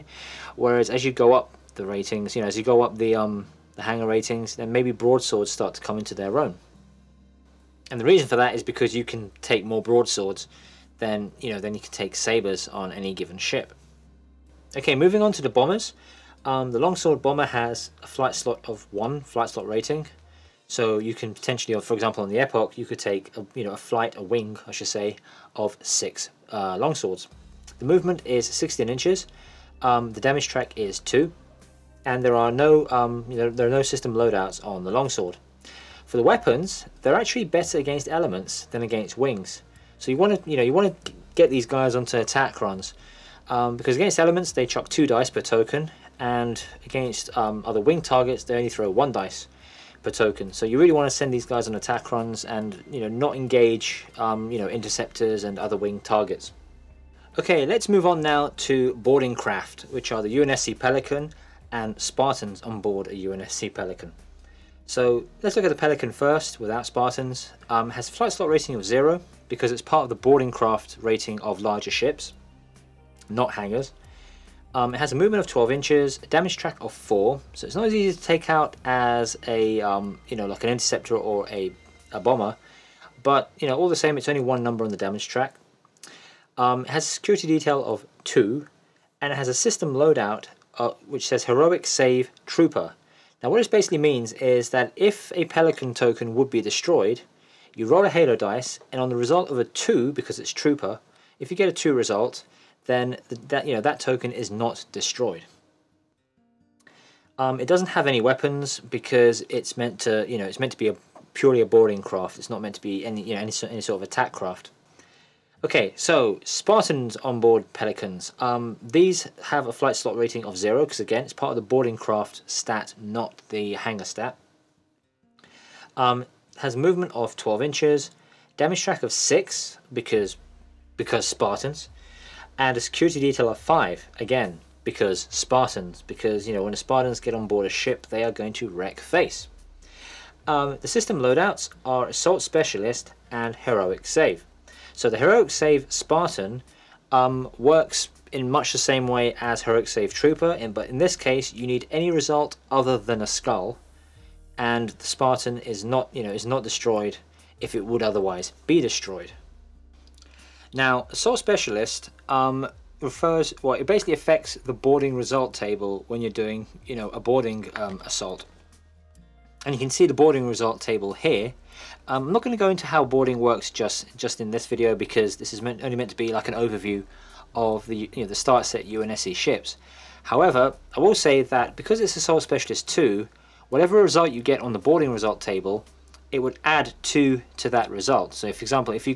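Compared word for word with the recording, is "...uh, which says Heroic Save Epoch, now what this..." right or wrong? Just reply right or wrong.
wrong.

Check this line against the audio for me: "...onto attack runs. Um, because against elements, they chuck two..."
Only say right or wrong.
right.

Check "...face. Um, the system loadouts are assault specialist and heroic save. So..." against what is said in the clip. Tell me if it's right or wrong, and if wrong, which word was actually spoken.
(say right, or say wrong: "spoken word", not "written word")
right.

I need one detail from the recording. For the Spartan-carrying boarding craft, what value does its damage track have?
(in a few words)
6.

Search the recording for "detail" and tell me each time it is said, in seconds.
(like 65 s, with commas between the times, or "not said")
87 s, 133 s.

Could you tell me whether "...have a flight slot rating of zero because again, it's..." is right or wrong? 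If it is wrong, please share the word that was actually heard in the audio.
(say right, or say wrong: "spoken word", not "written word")
right.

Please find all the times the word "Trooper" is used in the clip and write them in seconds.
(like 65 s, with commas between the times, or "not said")
92 s, 100 s, 150 s.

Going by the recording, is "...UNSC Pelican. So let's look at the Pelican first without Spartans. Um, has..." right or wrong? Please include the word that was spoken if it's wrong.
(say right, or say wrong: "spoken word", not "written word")
right.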